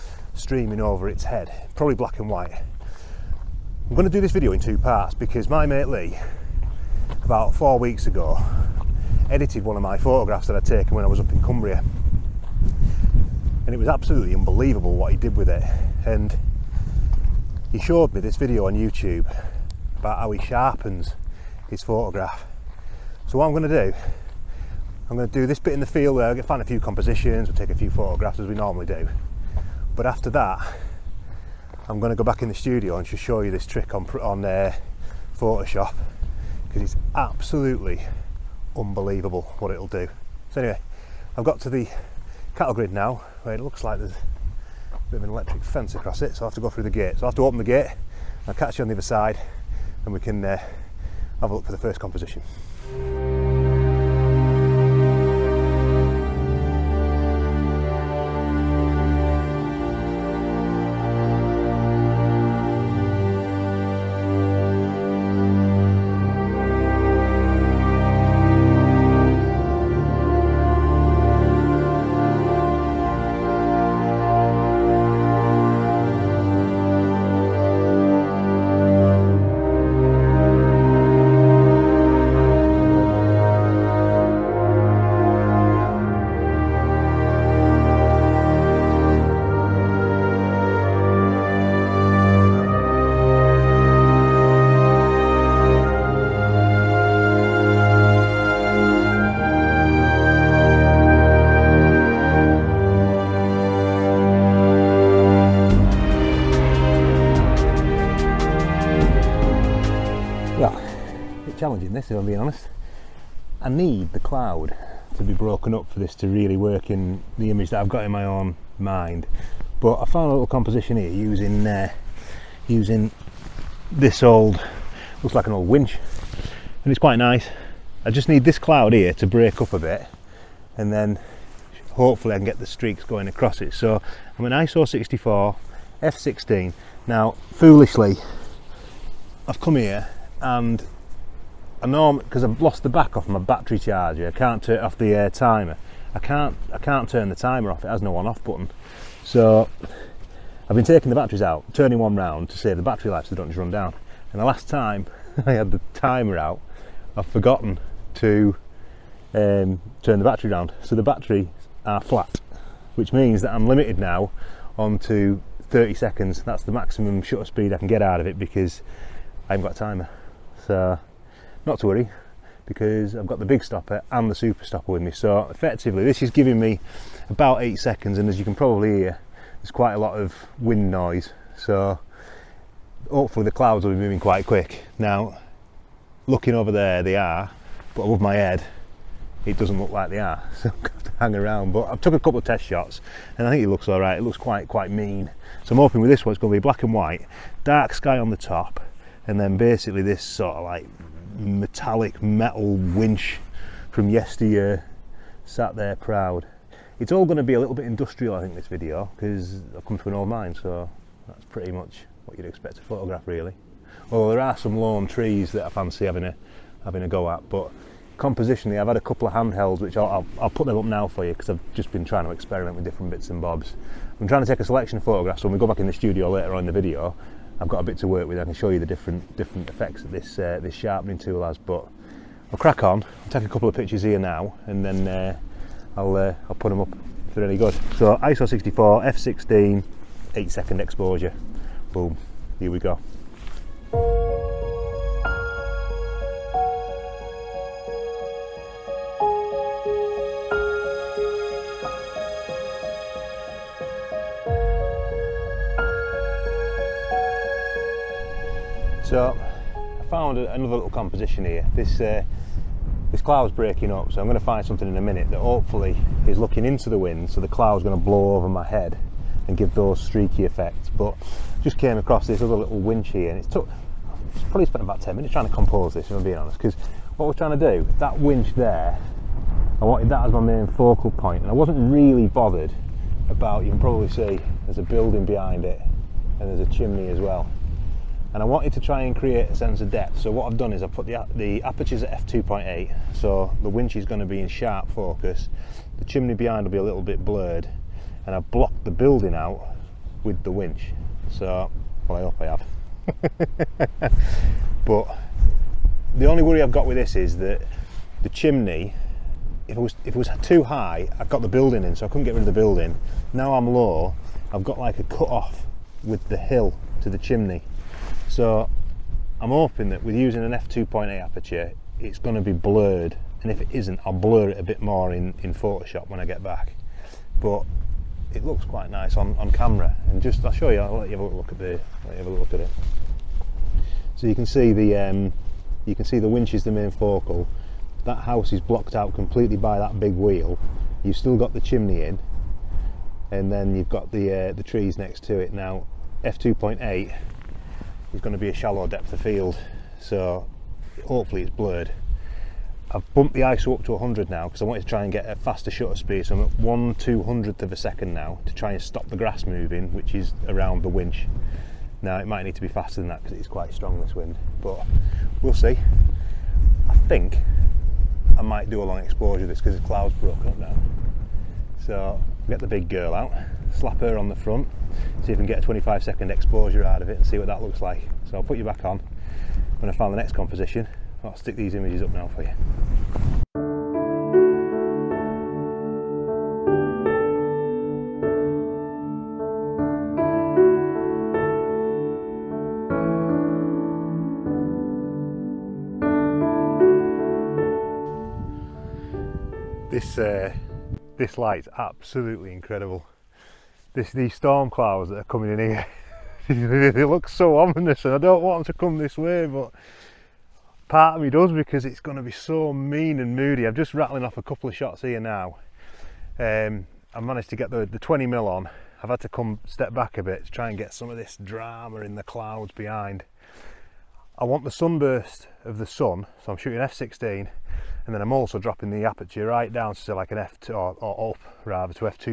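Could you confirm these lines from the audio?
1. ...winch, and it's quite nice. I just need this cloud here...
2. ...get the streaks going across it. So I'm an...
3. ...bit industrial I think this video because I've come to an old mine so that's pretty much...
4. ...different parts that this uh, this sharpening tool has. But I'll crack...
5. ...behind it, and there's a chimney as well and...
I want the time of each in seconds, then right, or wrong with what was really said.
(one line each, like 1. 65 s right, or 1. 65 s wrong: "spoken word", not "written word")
1. 125 s right
2. 132 s right
3. 207 s right
4. 229 s wrong: "effects", not "parts"
5. 285 s right.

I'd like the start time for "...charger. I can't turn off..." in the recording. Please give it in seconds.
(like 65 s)
143 s.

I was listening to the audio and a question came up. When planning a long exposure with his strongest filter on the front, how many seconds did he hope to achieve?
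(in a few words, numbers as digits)
25 seconds.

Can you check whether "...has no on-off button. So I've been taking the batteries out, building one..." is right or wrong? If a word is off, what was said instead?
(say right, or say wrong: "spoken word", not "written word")
wrong: "turning", not "building".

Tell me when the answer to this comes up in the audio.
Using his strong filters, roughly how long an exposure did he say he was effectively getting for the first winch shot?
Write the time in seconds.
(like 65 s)
177 s.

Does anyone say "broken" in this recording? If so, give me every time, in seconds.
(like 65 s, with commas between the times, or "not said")
115 s, 370 s.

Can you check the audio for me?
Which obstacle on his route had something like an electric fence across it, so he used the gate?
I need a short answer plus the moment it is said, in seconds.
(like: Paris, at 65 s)
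cattle grid, at 42 s.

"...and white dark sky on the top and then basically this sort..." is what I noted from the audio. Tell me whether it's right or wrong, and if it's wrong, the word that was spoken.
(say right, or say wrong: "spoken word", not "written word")
right.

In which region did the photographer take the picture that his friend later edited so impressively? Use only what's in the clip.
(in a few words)
Cumbria.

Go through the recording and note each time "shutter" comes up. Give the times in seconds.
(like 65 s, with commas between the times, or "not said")
167 s, 355 s.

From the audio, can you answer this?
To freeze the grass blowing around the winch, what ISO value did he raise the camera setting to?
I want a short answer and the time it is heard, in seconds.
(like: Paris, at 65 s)
100, at 353 s.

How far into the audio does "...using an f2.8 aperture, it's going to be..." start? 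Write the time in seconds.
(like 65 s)
320 s.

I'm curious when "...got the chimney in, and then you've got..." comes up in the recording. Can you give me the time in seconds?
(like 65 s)
341 s.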